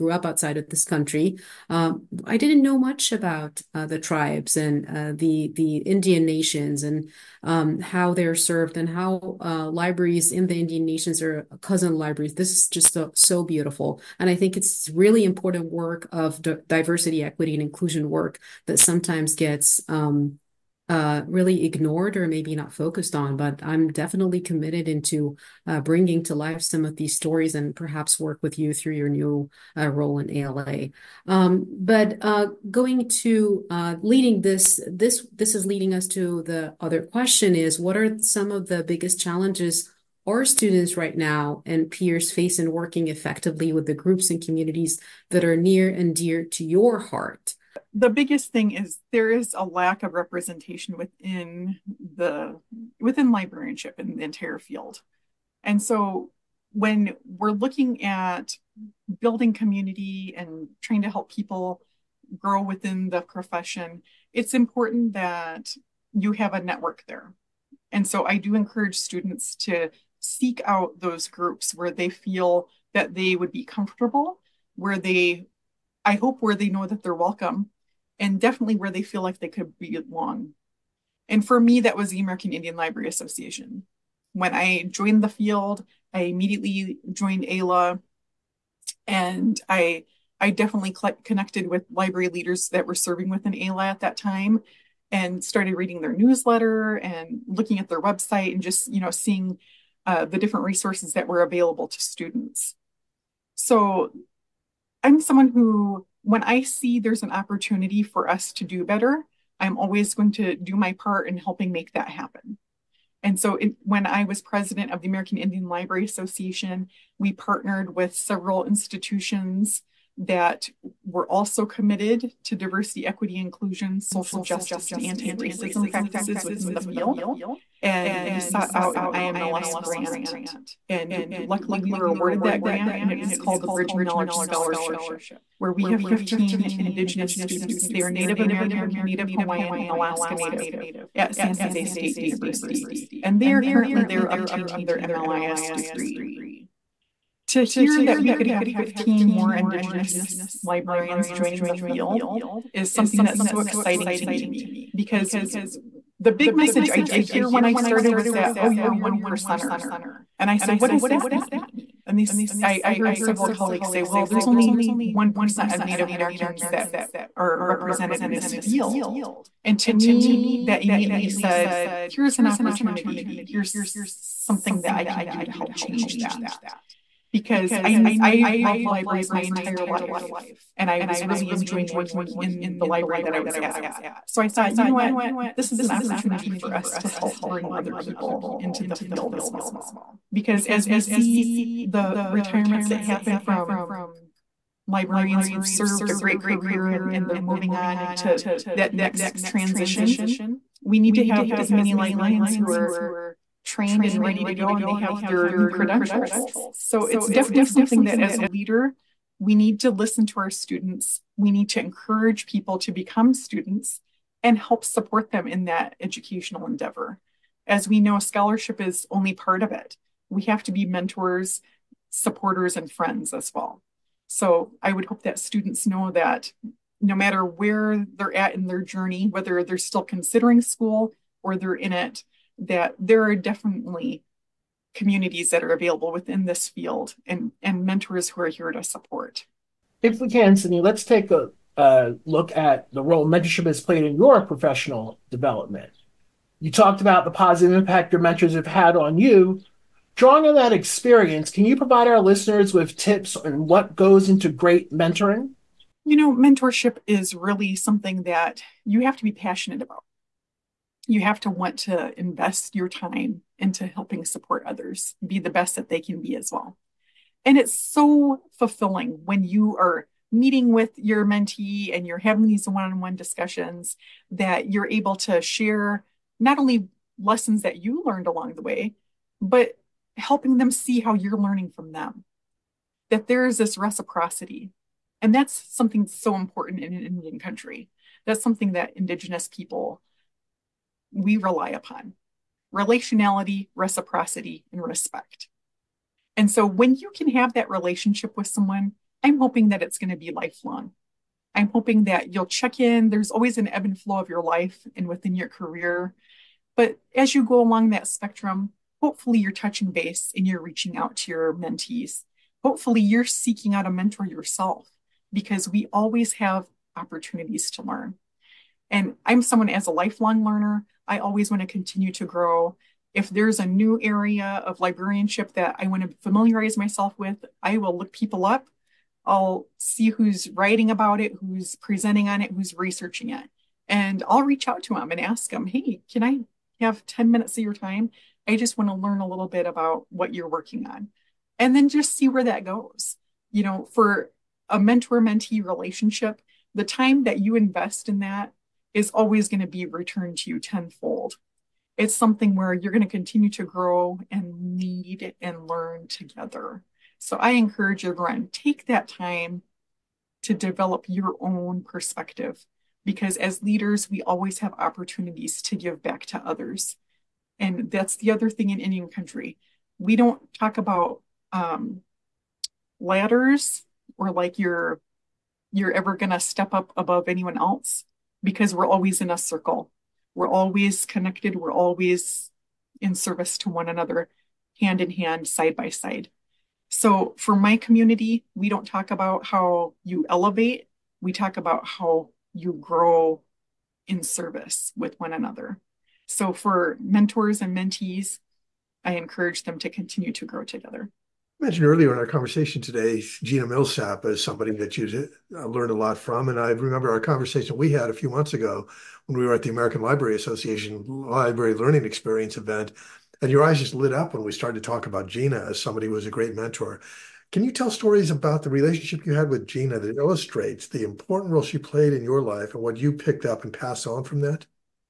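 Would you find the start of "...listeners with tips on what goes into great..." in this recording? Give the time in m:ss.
4:12.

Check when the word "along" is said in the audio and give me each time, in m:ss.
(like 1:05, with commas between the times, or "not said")
4:38, 5:07.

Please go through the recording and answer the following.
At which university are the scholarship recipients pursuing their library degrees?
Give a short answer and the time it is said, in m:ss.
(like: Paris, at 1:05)
San Jose State University, at 2:21.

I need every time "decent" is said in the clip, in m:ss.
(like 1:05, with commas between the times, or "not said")
not said.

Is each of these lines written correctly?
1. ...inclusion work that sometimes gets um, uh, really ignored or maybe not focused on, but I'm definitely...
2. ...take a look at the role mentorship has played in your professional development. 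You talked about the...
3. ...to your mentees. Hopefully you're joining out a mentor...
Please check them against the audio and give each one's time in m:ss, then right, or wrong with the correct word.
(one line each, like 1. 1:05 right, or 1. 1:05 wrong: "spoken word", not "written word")
1. 0:17 right
2. 4:01 right
3. 5:11 wrong: "seeking", not "joining".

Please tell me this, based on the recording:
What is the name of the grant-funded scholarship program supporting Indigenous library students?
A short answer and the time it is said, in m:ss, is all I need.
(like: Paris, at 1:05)
Bridging Knowledge Scholarship, at 2:13.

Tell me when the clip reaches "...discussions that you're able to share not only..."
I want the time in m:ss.
4:33.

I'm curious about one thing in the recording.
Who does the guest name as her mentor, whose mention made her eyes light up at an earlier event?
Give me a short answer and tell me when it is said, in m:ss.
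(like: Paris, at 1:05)
Gina Millsap, at 6:43.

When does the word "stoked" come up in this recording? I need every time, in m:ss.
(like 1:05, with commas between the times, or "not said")
not said.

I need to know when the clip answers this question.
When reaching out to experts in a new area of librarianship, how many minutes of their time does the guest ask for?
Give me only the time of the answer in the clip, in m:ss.
5:37.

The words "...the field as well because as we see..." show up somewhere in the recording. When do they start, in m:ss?
3:08.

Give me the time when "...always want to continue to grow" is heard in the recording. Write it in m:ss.
5:21.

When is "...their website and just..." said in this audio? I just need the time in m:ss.
1:37.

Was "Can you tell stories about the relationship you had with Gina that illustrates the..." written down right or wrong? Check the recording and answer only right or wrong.
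right.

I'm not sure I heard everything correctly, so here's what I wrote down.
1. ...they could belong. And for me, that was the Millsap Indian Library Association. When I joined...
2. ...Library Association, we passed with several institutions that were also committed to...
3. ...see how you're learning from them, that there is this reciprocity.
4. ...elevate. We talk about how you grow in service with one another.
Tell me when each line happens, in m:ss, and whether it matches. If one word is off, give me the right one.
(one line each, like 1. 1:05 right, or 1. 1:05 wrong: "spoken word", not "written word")
1. 1:19 wrong: "American", not "Millsap"
2. 1:55 wrong: "partnered", not "passed"
3. 4:40 right
4. 6:30 right.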